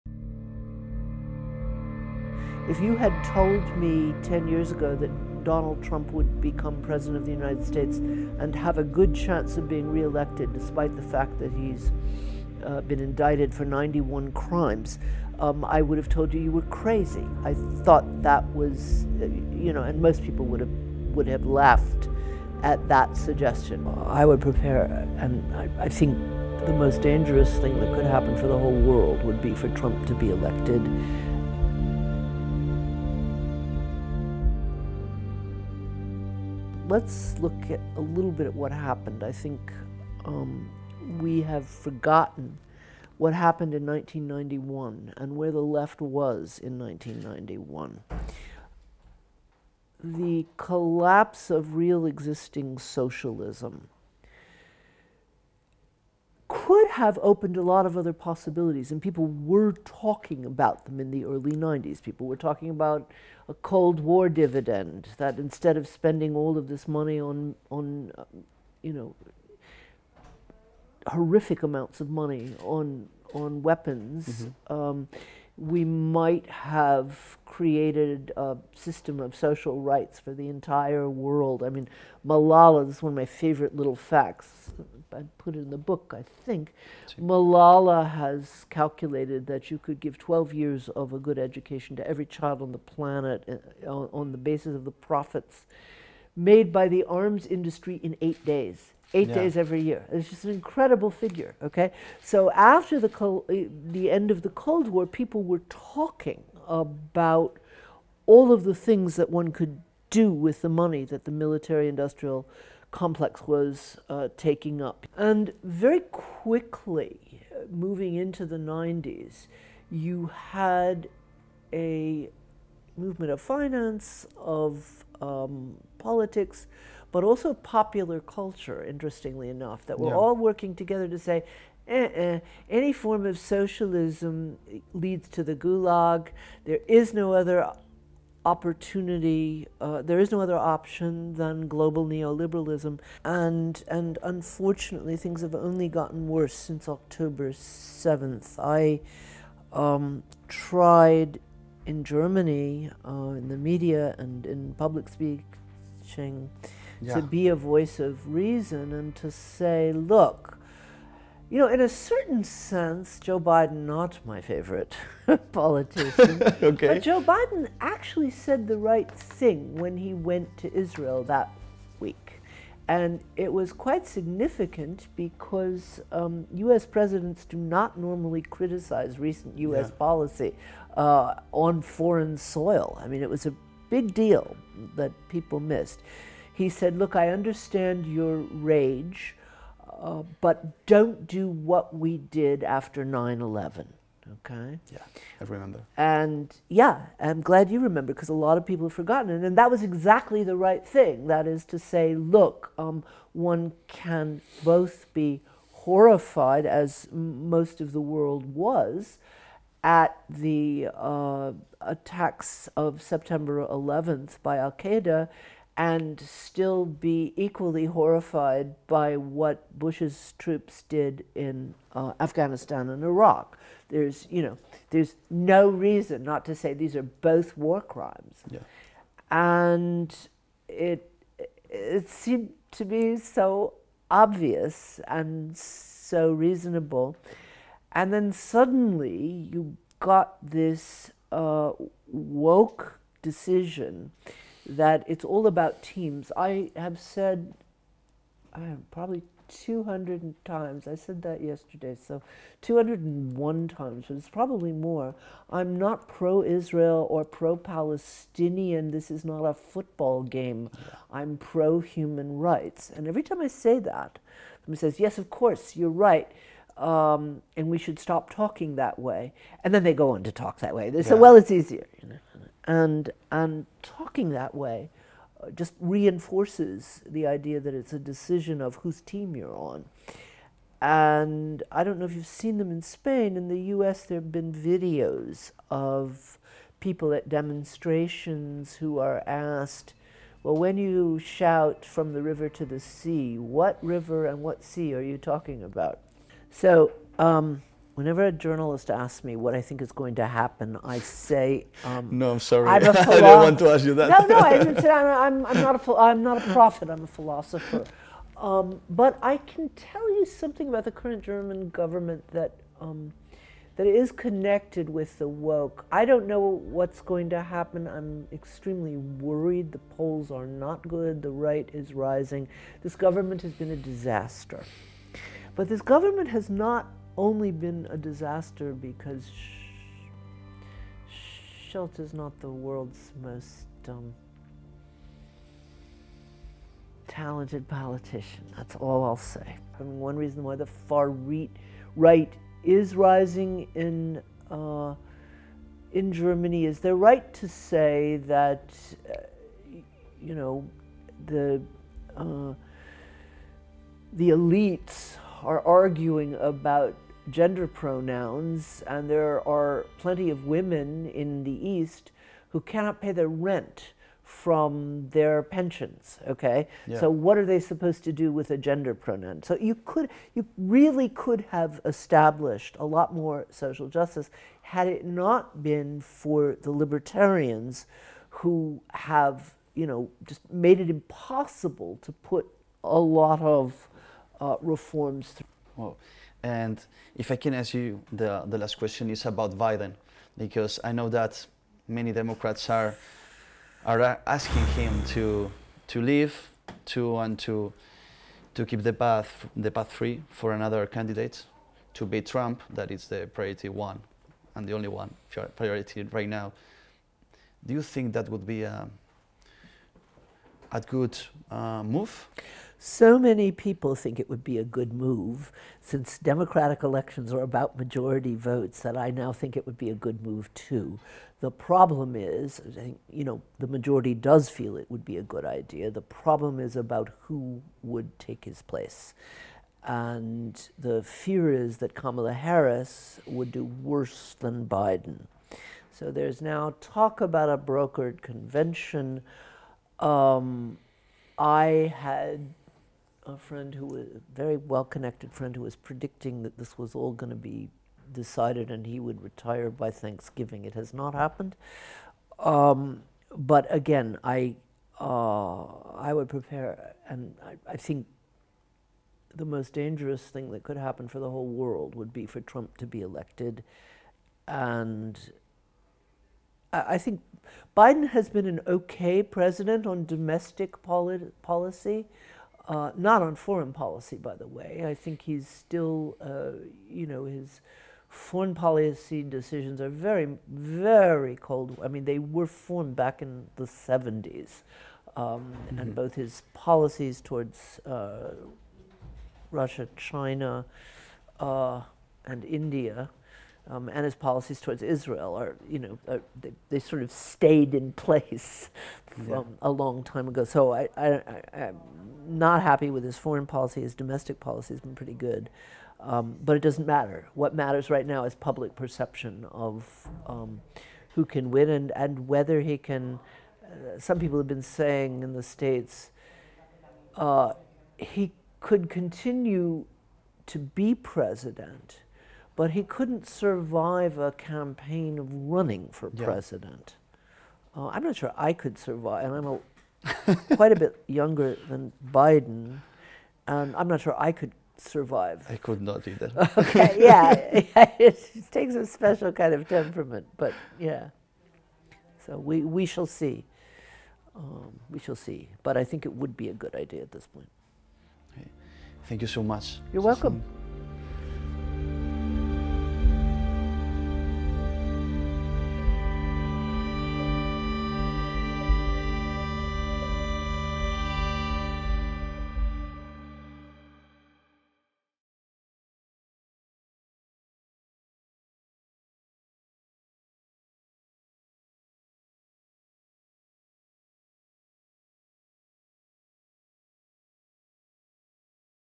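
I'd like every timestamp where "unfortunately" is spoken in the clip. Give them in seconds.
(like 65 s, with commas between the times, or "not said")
144 s.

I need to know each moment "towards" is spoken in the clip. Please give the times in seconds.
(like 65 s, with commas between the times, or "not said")
487 s, 494 s.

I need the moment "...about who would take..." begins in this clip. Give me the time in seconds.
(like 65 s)
426 s.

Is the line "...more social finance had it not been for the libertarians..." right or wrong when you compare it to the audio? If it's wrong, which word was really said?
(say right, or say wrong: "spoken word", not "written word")
wrong: "justice", not "finance".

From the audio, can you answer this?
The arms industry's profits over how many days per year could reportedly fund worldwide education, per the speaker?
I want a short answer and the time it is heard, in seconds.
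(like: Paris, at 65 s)
8, at 98 s.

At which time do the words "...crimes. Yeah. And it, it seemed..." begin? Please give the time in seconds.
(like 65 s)
227 s.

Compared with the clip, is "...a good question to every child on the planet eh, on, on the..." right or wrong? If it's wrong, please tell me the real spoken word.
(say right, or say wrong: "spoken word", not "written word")
wrong: "education", not "question".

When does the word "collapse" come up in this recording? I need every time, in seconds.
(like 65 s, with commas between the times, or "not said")
50 s.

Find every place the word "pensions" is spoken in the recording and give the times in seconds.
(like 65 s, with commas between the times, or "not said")
365 s.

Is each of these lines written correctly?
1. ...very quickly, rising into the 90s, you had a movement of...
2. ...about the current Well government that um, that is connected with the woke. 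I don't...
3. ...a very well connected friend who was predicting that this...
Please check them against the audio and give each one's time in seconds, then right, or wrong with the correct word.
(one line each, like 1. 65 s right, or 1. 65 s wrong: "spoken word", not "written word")
1. 115 s wrong: "moving", not "rising"
2. 310 s wrong: "German", not "Well"
3. 444 s right.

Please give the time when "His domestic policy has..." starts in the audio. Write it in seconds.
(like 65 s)
503 s.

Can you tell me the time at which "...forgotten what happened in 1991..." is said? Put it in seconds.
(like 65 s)
41 s.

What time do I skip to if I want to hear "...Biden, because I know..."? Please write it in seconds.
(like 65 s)
389 s.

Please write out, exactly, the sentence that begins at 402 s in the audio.
That is the priority one and the only one priority right now.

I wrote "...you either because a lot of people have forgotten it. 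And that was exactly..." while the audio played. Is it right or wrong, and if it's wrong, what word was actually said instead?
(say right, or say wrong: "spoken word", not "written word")
wrong: "remember", not "either".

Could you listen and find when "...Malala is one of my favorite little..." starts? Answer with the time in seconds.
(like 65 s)
82 s.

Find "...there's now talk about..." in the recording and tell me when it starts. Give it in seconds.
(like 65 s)
436 s.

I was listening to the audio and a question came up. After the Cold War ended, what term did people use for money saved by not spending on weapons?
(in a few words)
Cold War dividend.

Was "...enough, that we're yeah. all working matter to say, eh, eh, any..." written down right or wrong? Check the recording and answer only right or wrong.
wrong.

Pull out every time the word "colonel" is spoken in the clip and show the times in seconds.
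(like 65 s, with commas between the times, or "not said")
not said.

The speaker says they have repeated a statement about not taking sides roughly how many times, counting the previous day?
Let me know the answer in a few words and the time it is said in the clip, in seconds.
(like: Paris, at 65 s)
201, at 252 s.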